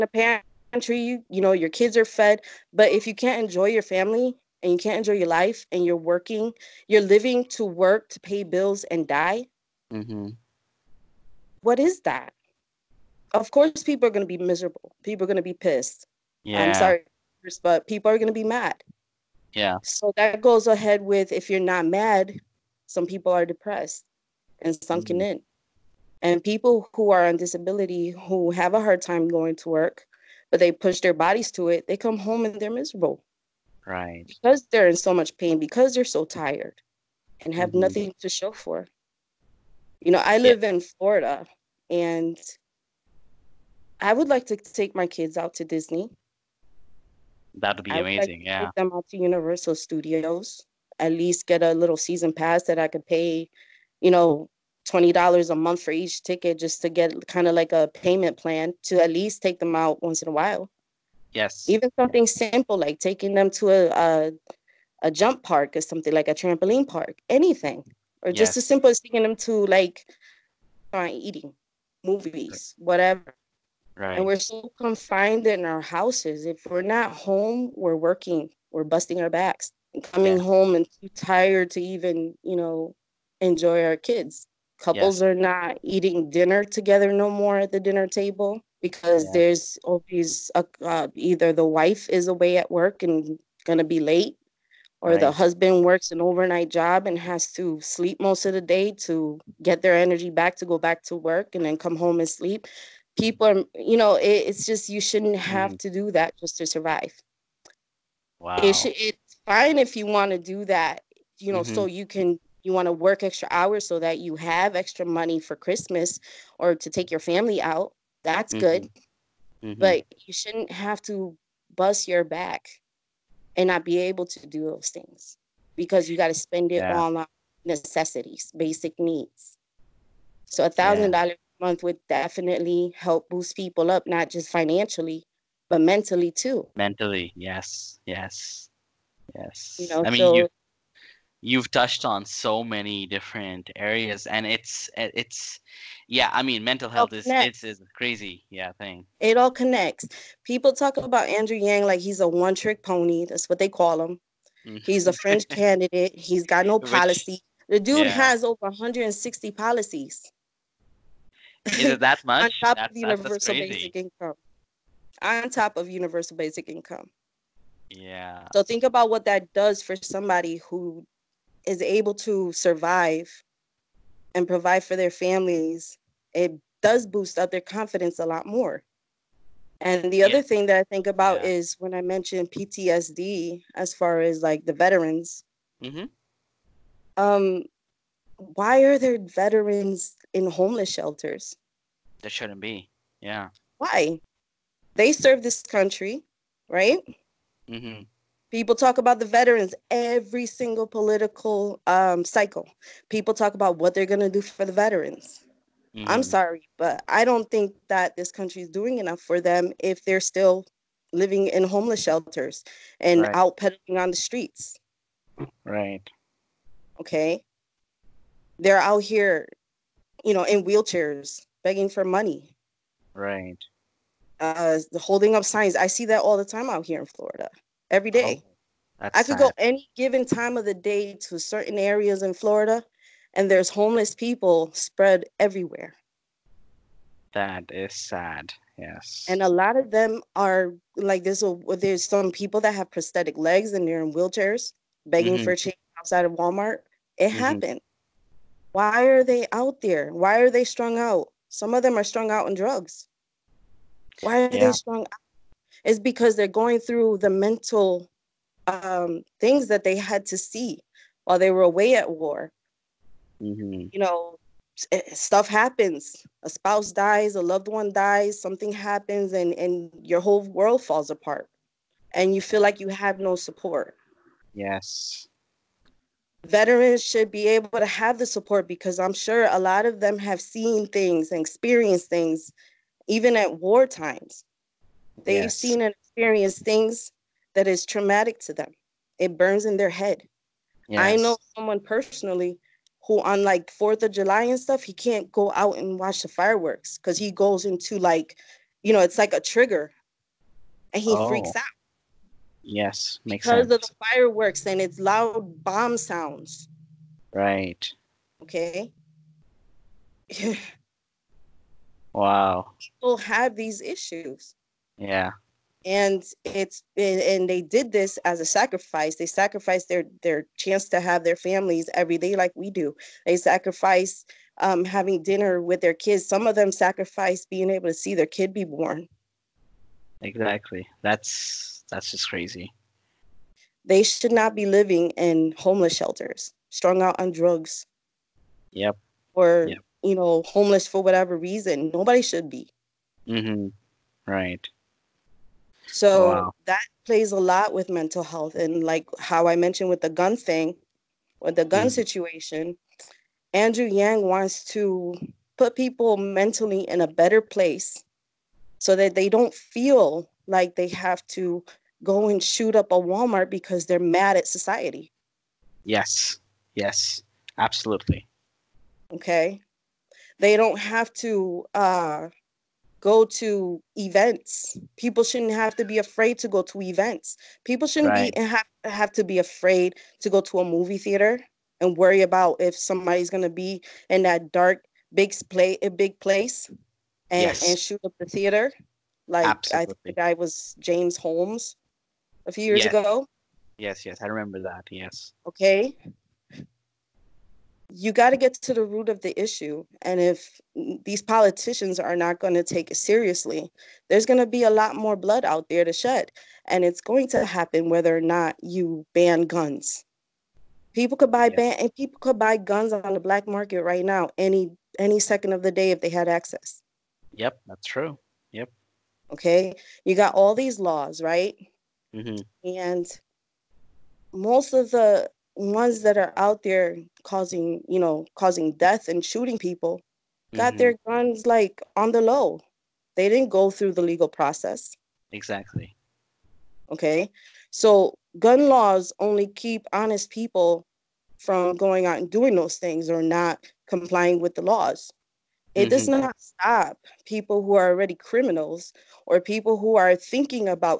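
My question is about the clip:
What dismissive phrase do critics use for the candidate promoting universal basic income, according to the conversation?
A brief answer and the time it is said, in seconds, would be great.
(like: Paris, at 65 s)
one trick pony, at 152 s.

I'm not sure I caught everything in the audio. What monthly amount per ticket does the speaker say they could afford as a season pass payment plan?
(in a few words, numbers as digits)
$20.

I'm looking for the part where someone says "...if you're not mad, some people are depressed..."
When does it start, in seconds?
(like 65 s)
21 s.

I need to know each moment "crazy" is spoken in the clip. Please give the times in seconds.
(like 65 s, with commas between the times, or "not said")
147 s, 332 s.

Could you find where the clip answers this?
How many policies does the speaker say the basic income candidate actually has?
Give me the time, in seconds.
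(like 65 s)
158 s.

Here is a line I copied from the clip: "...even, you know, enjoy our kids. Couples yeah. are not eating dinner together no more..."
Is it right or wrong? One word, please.
right.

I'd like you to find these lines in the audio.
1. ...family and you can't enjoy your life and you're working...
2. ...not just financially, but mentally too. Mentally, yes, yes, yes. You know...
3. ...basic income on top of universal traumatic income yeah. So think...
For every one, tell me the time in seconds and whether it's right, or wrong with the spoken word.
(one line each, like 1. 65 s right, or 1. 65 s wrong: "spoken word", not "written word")
1. 3 s right
2. 134 s right
3. 163 s wrong: "basic", not "traumatic".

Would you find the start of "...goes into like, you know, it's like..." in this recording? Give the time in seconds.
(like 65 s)
297 s.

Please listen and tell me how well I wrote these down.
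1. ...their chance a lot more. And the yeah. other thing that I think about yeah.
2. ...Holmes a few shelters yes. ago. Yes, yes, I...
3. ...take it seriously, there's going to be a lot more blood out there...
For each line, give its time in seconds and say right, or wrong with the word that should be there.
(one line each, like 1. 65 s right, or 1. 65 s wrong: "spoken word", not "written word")
1. 177 s wrong: "confidence", not "chance"
2. 391 s wrong: "years", not "shelters"
3. 402 s right.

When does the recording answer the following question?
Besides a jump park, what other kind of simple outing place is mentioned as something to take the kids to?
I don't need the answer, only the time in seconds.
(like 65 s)
66 s.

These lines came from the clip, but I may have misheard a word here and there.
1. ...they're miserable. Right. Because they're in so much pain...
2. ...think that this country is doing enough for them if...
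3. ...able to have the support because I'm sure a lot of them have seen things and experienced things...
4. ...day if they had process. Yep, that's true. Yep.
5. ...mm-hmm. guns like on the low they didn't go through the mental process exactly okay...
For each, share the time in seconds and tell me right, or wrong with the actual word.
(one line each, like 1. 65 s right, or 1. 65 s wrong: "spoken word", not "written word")
1. 32 s right
2. 207 s right
3. 277 s right
4. 415 s wrong: "access", not "process"
5. 430 s wrong: "legal", not "mental".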